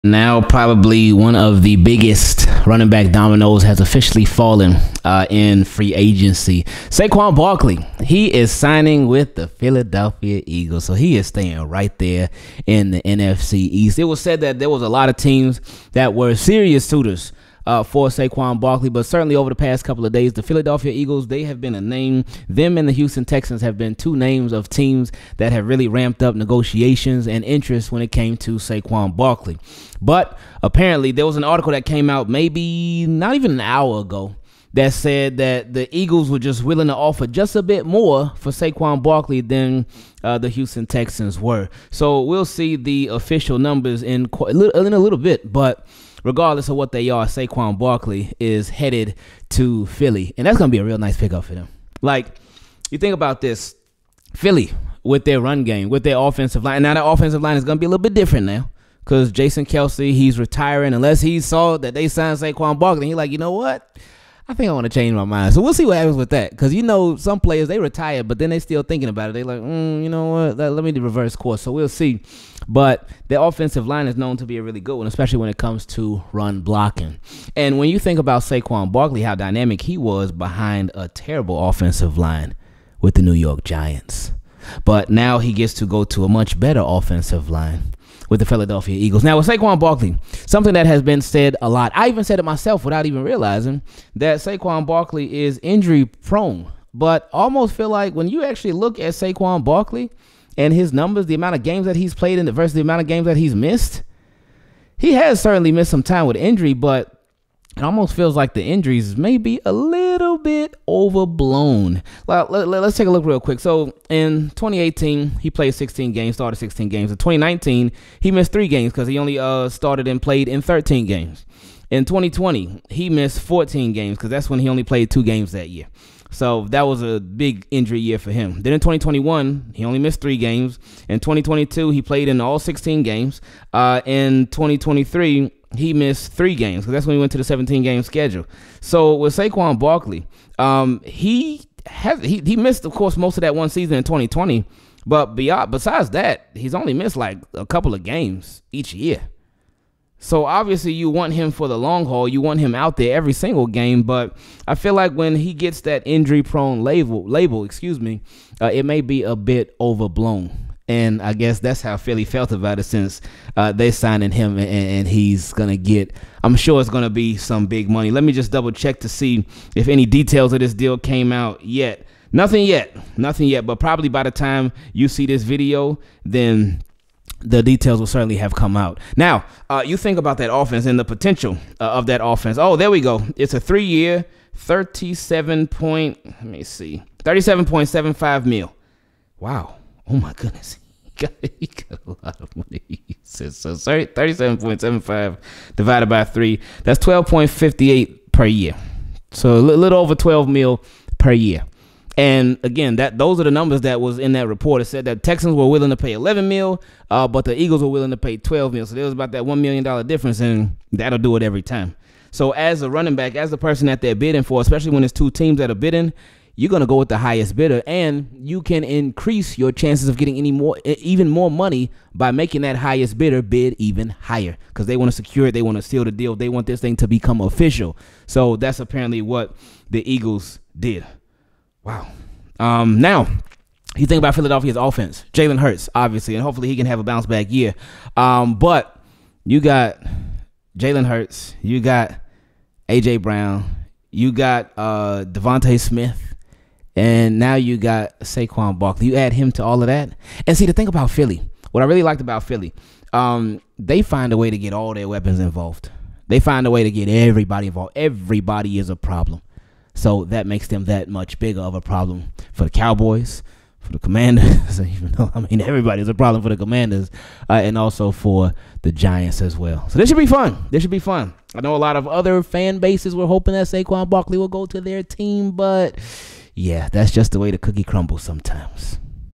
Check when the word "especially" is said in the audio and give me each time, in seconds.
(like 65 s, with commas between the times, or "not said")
75 s, 214 s.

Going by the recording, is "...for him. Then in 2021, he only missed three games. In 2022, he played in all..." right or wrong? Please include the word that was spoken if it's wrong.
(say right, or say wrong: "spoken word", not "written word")
right.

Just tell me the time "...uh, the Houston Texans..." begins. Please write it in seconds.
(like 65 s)
40 s.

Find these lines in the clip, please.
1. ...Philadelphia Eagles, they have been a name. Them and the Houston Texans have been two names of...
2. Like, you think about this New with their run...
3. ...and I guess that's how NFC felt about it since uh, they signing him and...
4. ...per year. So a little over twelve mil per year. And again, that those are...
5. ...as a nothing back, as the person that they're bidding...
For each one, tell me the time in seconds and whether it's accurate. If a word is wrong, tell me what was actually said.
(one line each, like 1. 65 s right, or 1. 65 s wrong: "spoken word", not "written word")
1. 20 s right
2. 52 s wrong: "Philly", not "New"
3. 160 s wrong: "Philly", not "NFC"
4. 198 s right
5. 212 s wrong: "running", not "nothing".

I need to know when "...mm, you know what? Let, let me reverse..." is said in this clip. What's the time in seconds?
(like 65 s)
69 s.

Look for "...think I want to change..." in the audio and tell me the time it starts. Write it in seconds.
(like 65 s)
64 s.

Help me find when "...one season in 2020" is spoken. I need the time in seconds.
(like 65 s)
143 s.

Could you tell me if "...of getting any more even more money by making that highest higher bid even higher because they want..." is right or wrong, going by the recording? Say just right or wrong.
wrong.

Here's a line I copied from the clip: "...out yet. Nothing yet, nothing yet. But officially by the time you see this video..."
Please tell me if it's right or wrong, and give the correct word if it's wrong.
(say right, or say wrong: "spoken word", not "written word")
wrong: "probably", not "officially".